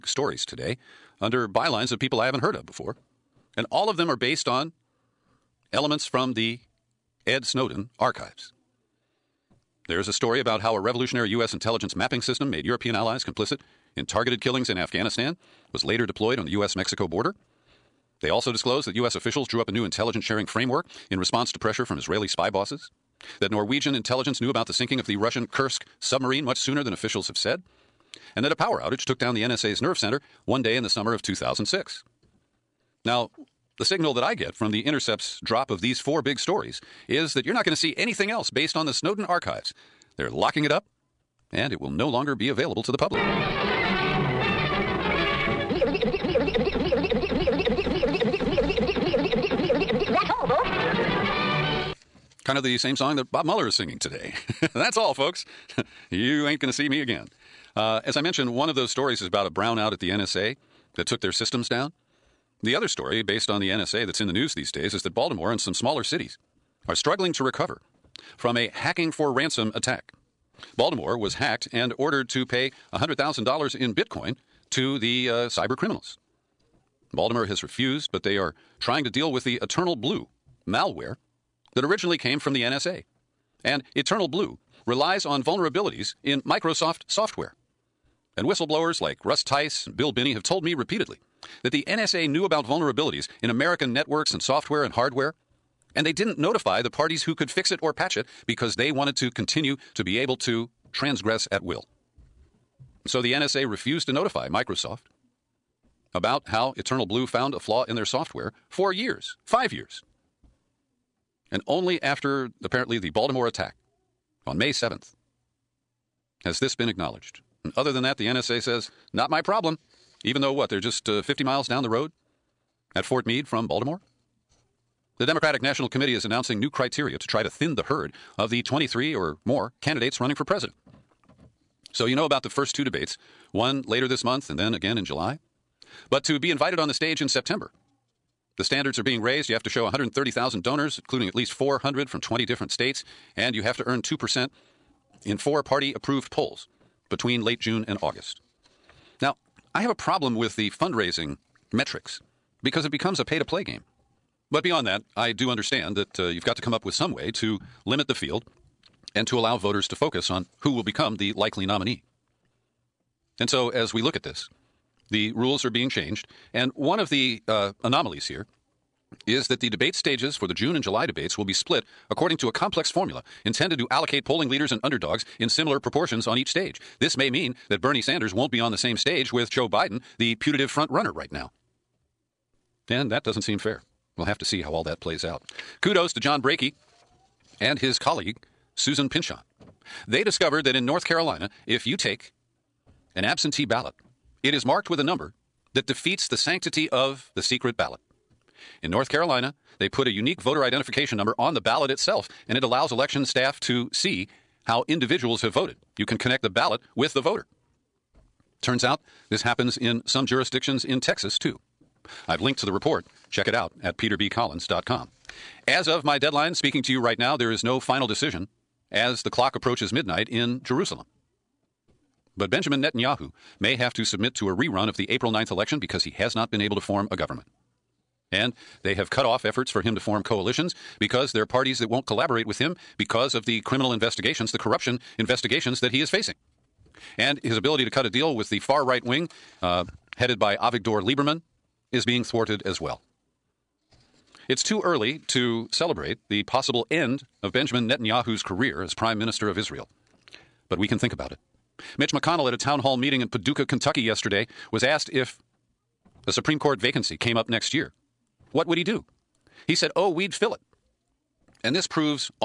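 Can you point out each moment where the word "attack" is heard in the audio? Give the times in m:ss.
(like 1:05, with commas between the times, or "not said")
1:09, 1:53.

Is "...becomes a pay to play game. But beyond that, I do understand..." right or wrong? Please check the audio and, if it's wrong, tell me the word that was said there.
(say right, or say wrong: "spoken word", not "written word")
right.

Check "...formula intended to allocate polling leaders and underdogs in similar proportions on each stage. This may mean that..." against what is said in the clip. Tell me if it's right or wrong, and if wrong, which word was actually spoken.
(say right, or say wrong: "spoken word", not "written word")
right.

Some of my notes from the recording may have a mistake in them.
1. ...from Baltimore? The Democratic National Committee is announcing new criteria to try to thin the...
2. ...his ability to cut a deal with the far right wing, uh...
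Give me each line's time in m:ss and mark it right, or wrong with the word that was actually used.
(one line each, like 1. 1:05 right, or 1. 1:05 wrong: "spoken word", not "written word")
1. 2:03 right
2. 3:57 right.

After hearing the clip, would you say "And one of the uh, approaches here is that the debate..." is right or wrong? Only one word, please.
wrong.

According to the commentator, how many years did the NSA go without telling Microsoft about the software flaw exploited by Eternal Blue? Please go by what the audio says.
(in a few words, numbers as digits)
5 years.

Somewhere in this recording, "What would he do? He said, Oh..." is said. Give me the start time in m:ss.
4:18.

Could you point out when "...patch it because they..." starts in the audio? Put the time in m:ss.
1:37.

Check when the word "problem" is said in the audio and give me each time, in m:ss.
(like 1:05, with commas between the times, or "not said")
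1:59, 2:29.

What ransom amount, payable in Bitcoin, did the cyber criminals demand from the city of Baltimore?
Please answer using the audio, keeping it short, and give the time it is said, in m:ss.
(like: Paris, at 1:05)
$100,000, at 1:12.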